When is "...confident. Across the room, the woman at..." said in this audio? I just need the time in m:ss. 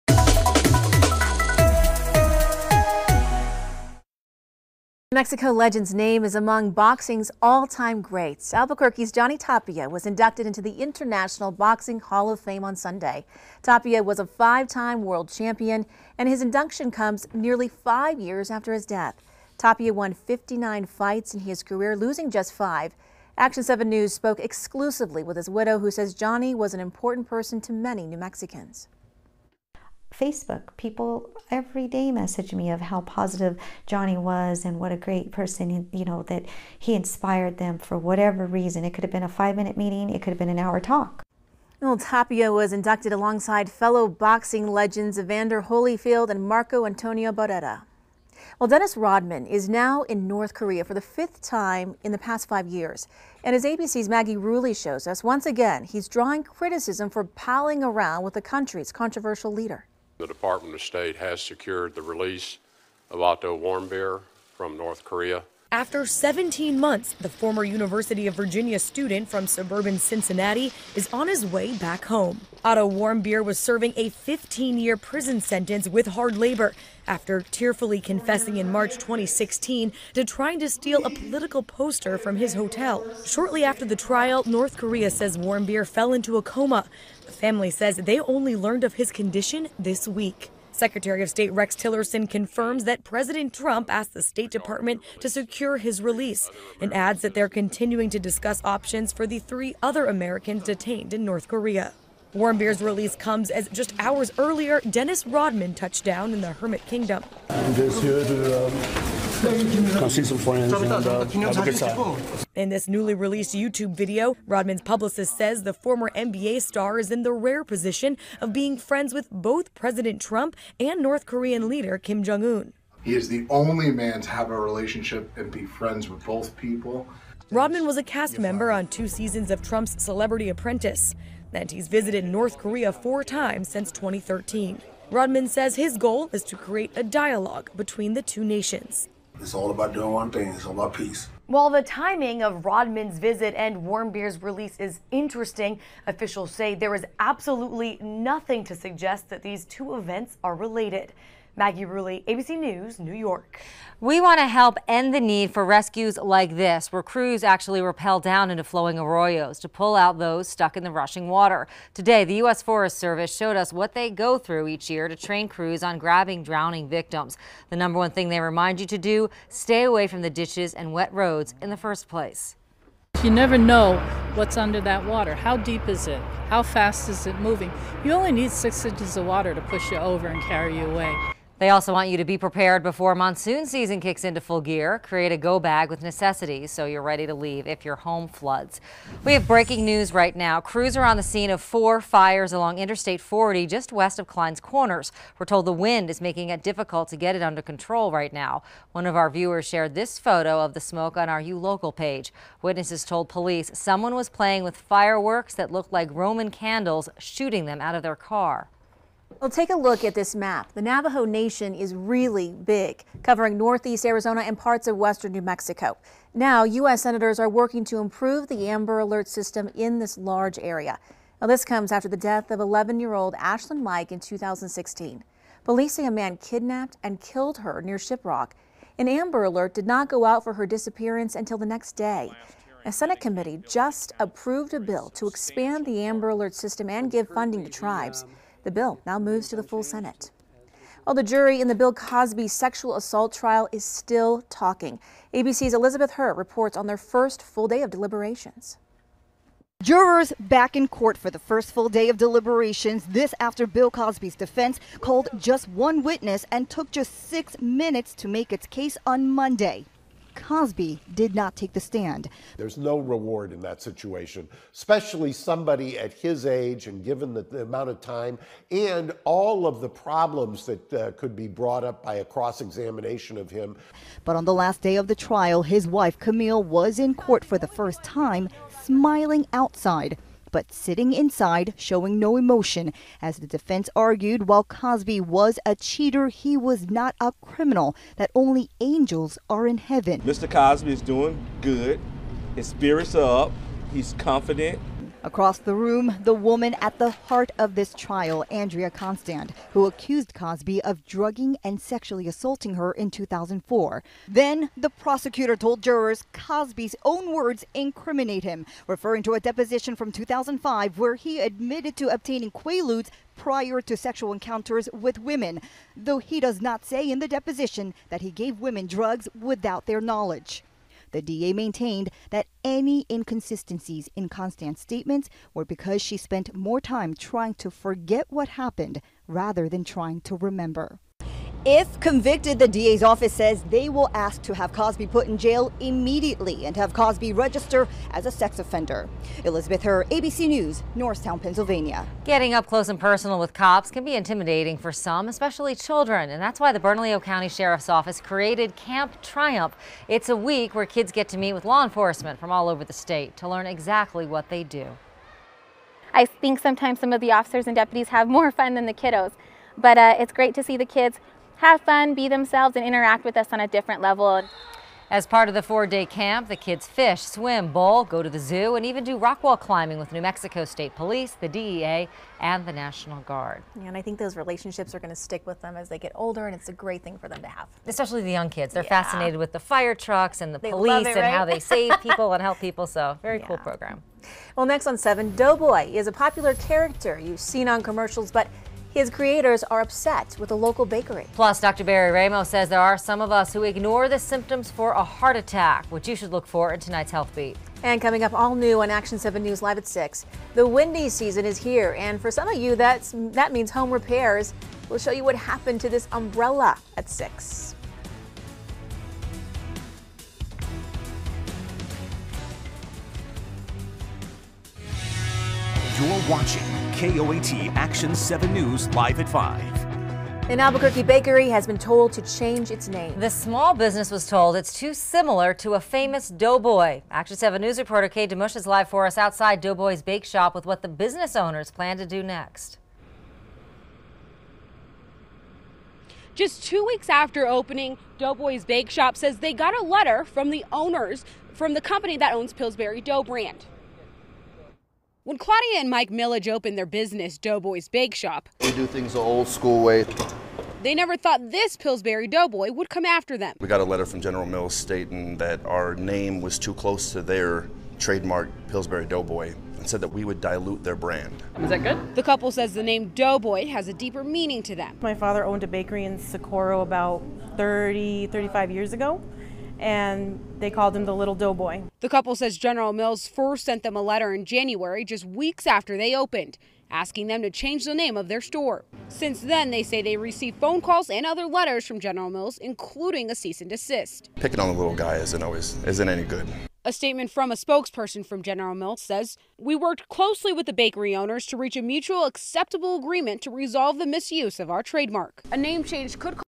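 4:54.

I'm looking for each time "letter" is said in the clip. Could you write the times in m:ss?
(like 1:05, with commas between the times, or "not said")
7:19, 7:33, 7:54, 8:01.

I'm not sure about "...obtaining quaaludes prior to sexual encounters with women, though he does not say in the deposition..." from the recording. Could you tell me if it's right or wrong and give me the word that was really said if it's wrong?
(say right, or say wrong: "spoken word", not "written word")
right.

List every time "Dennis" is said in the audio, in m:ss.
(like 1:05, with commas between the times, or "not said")
0:48, 1:44.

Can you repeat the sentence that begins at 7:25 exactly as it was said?
When Claudia and Mike Millage opened their business, Doughboy's Bake Shop, we do things the old school way.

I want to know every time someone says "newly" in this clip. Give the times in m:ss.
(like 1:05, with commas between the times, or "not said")
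1:52.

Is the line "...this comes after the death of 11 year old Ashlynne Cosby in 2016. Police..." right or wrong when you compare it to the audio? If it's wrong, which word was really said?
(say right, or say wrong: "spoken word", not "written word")
wrong: "Mike", not "Cosby".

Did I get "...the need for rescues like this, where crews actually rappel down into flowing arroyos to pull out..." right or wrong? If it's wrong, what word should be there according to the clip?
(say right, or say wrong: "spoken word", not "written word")
right.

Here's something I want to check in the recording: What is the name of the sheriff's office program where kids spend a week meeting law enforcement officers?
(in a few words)
Camp Triumph.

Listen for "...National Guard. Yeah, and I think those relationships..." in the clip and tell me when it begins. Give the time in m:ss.
6:12.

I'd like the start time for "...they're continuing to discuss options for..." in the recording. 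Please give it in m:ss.
1:37.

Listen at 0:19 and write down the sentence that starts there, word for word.
Tapia won 59 fights in his career, losing just five.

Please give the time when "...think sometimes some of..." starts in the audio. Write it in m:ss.
5:56.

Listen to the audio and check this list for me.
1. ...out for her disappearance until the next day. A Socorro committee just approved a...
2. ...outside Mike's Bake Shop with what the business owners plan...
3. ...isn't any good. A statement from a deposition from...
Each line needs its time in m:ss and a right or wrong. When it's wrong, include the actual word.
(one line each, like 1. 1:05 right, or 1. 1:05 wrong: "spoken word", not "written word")
1. 3:50 wrong: "Senate", not "Socorro"
2. 7:09 wrong: "Doughboy", not "Mike"
3. 8:05 wrong: "spokesperson", not "deposition".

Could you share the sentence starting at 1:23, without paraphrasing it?
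Shortly after the trial, North Korea says Warmbier fell into a coma.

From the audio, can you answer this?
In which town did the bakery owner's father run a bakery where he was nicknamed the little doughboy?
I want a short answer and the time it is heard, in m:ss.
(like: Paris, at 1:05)
Socorro, at 7:46.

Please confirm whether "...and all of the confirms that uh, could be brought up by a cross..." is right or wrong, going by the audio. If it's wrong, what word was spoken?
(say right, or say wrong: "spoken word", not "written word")
wrong: "problems", not "confirms".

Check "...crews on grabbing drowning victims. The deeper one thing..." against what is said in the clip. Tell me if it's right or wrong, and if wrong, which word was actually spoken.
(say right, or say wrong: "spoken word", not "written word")
wrong: "number", not "deeper".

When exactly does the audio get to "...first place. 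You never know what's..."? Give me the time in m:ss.
2:51.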